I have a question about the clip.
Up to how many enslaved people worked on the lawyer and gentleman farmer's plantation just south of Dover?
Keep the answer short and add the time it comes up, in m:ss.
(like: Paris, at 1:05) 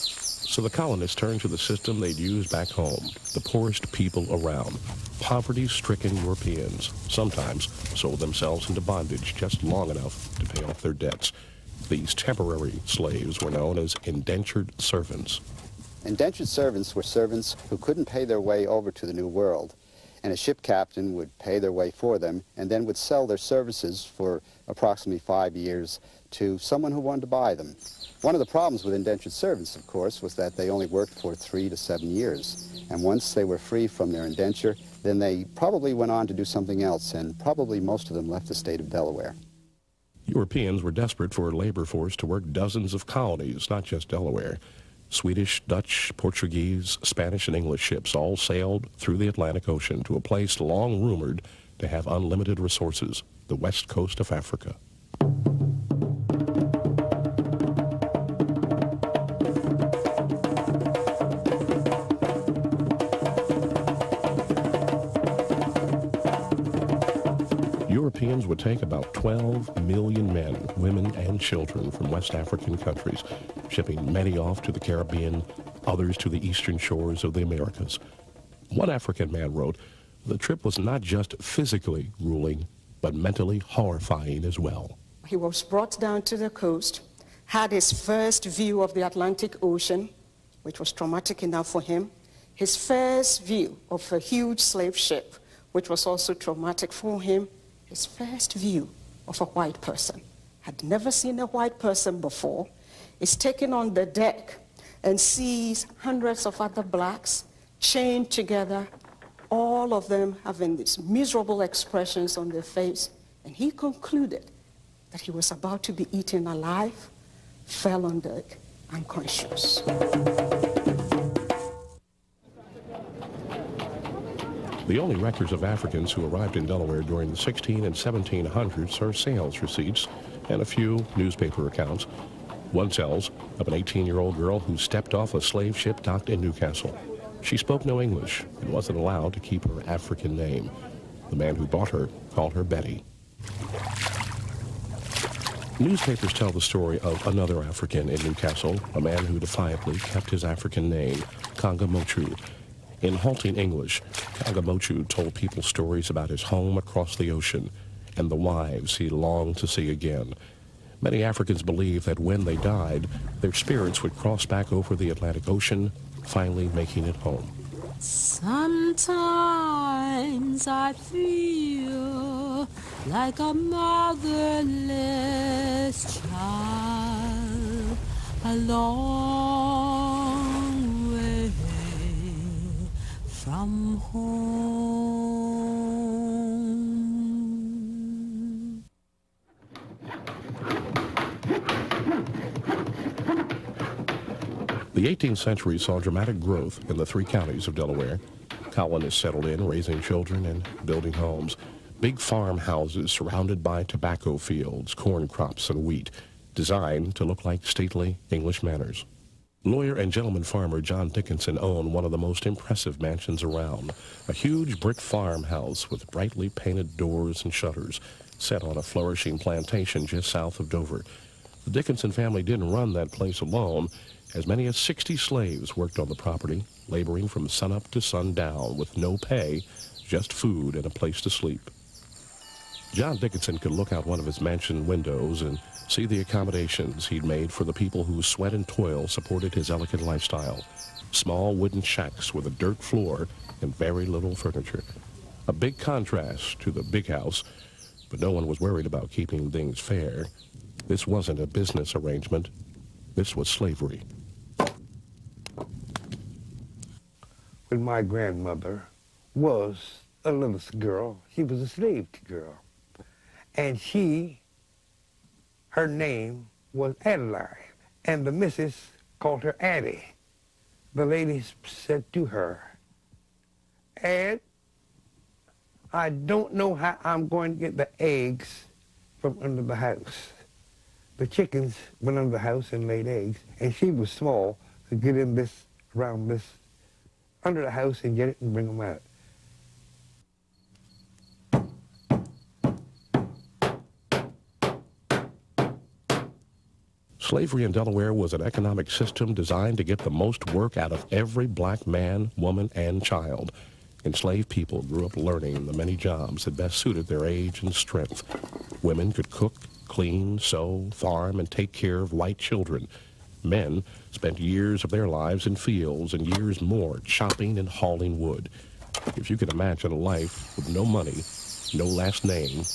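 60, at 3:44.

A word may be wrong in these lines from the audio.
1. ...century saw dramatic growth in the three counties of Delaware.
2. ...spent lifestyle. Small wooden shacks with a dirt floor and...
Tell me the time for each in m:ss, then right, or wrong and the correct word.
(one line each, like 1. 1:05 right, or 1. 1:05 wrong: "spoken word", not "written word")
1. 3:15 right
2. 3:59 wrong: "elegant", not "spent".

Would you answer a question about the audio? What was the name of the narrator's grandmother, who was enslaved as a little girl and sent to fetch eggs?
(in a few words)
Adeline.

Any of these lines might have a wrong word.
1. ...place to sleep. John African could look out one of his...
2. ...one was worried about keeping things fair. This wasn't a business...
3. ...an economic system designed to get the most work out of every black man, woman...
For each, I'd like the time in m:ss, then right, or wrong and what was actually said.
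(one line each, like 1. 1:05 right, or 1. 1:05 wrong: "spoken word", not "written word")
1. 3:50 wrong: "Dickinson", not "African"
2. 4:08 right
3. 4:58 right.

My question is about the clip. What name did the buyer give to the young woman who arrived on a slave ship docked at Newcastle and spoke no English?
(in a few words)
Betty.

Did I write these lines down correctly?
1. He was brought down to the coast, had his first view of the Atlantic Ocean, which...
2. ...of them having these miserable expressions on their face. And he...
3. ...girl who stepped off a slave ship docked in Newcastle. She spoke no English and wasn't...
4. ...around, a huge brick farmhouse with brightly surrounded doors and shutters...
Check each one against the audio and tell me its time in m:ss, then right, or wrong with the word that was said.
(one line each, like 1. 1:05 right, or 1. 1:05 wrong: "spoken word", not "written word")
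1. 1:25 right
2. 1:49 right
3. 2:14 right
4. 3:33 wrong: "painted", not "surrounded".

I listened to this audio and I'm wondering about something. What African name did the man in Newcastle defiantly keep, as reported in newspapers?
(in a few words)
Kanga Mochu.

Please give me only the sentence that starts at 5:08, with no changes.
Women could cook, clean, sew, farm, and take care of white children.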